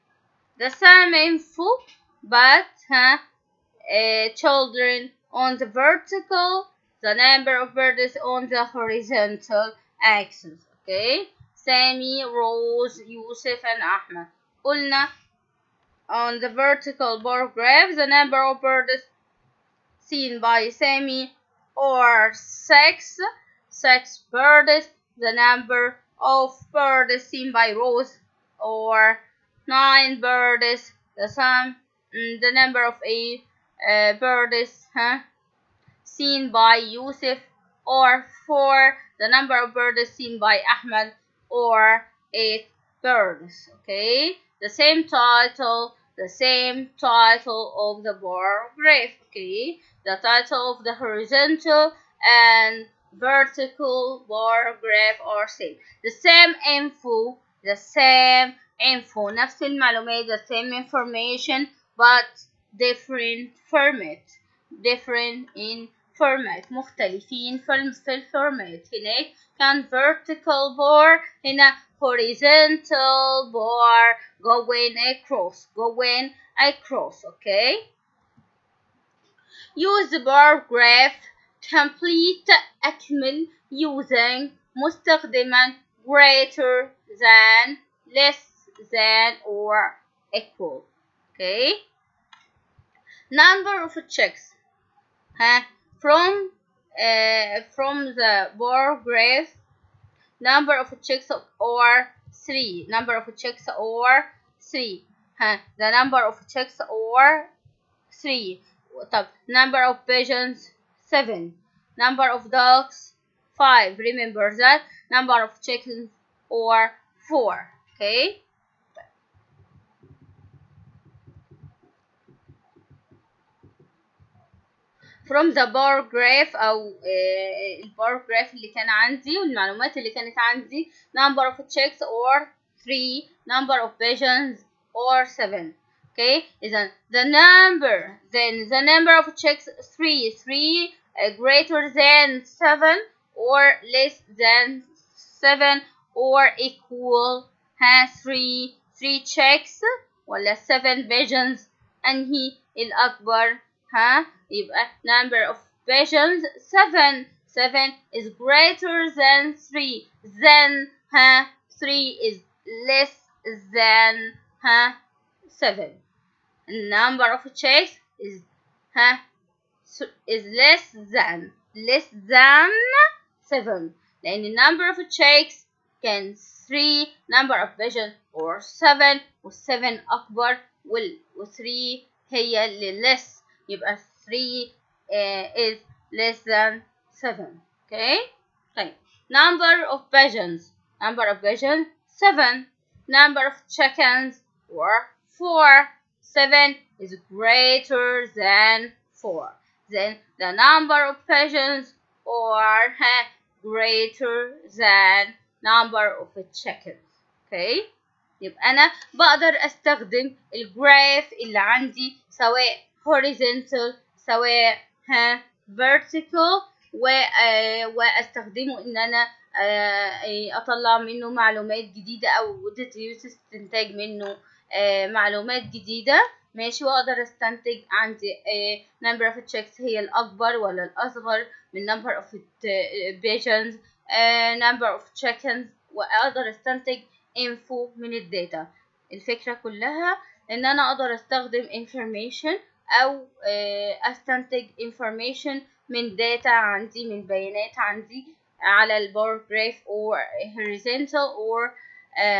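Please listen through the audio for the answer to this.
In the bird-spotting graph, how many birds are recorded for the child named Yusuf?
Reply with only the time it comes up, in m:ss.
0:38.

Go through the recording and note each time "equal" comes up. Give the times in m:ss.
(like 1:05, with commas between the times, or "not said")
1:30, 2:26.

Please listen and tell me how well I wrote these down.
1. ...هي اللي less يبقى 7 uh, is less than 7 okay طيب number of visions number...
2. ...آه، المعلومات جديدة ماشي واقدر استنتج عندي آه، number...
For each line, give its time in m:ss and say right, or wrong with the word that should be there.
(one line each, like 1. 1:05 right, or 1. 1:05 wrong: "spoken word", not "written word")
1. 3:02 wrong: "3", not "7"
2. 3:44 wrong: "معلومات", not "المعلومات".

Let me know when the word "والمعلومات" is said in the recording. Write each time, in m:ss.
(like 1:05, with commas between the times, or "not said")
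2:09.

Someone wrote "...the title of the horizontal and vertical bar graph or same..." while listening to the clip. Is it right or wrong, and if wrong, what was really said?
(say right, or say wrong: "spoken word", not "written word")
right.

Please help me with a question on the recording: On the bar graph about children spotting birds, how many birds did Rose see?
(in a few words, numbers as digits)
9.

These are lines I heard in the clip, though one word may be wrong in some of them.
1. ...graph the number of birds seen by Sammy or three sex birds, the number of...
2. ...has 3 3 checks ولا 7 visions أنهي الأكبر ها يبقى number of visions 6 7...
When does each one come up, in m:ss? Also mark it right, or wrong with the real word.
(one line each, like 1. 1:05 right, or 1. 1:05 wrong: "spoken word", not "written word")
1. 0:17 wrong: "six", not "three"
2. 2:27 wrong: "7", not "6".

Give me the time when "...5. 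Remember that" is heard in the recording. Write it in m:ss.
1:53.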